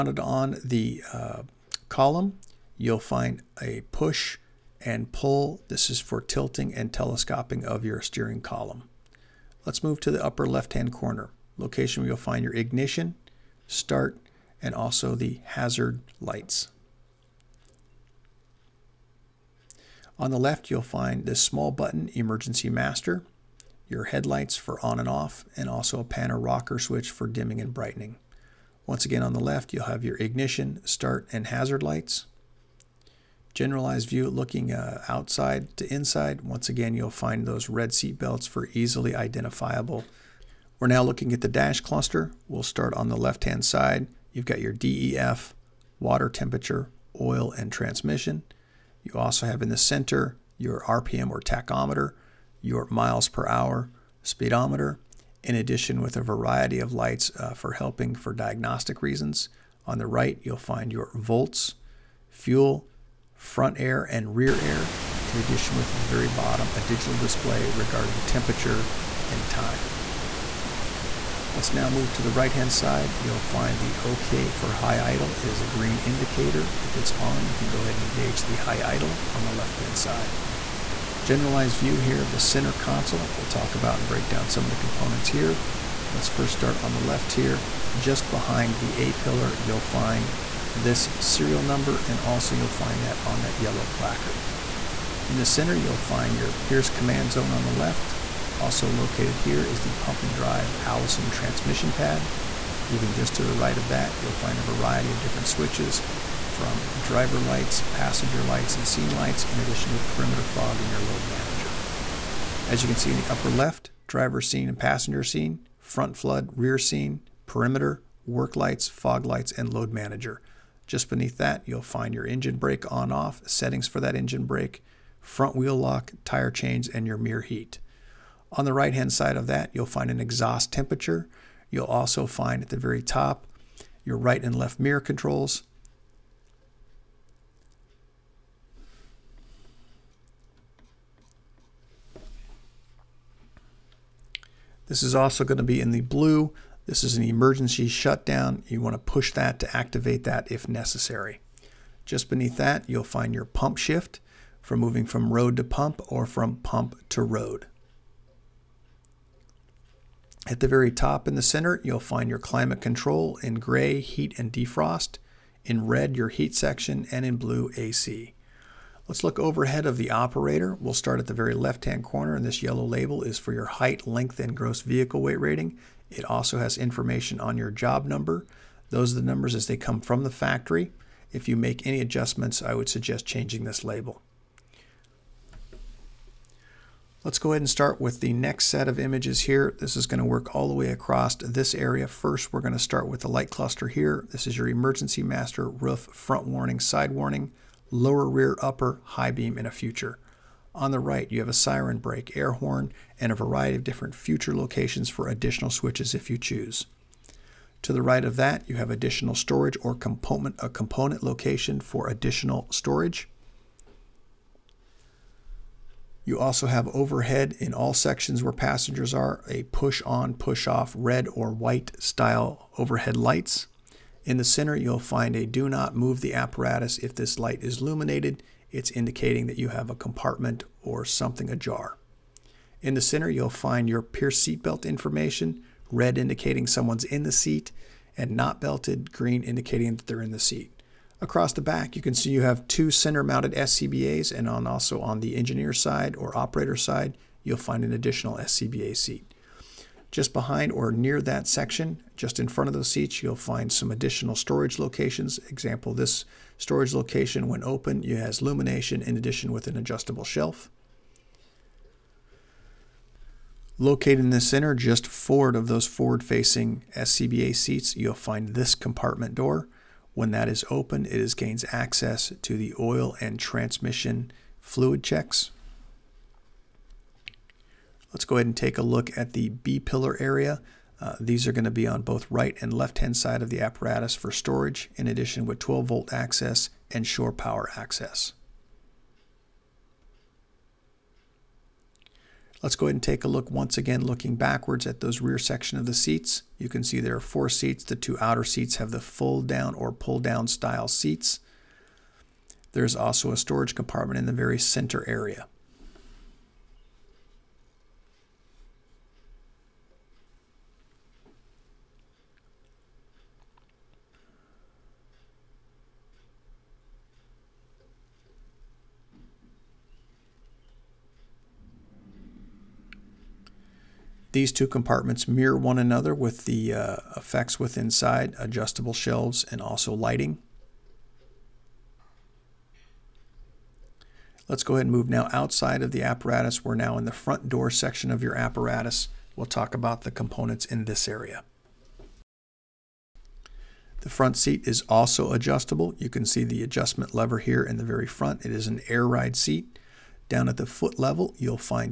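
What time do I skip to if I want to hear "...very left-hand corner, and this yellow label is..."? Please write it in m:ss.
2:51.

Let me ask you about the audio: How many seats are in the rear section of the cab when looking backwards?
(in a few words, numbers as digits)
4.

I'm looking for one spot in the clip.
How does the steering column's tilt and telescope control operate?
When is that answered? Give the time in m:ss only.
0:03.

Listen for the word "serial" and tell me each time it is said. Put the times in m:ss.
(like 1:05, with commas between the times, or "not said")
1:31.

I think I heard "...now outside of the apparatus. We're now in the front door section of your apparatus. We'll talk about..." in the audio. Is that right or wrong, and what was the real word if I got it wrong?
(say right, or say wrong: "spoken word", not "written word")
right.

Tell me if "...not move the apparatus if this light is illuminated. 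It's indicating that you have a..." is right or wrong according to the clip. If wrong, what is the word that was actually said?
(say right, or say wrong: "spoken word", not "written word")
right.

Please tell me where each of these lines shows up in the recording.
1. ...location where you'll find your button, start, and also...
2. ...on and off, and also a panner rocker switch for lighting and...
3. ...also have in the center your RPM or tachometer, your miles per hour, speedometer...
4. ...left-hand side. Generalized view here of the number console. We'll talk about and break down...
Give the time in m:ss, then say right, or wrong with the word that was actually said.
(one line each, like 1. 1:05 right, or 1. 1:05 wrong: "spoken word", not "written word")
1. 0:11 wrong: "ignition", not "button"
2. 0:24 wrong: "dimming", not "lighting"
3. 0:49 right
4. 1:19 wrong: "center", not "number".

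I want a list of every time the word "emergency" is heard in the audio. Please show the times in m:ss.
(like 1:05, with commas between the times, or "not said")
0:22, 2:27, 3:14.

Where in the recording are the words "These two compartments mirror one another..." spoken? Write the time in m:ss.
5:24.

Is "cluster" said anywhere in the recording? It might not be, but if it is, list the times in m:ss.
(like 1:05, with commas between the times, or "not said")
0:41, 3:13.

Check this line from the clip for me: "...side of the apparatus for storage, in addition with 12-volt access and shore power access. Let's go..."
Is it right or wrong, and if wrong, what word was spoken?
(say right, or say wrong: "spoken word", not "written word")
right.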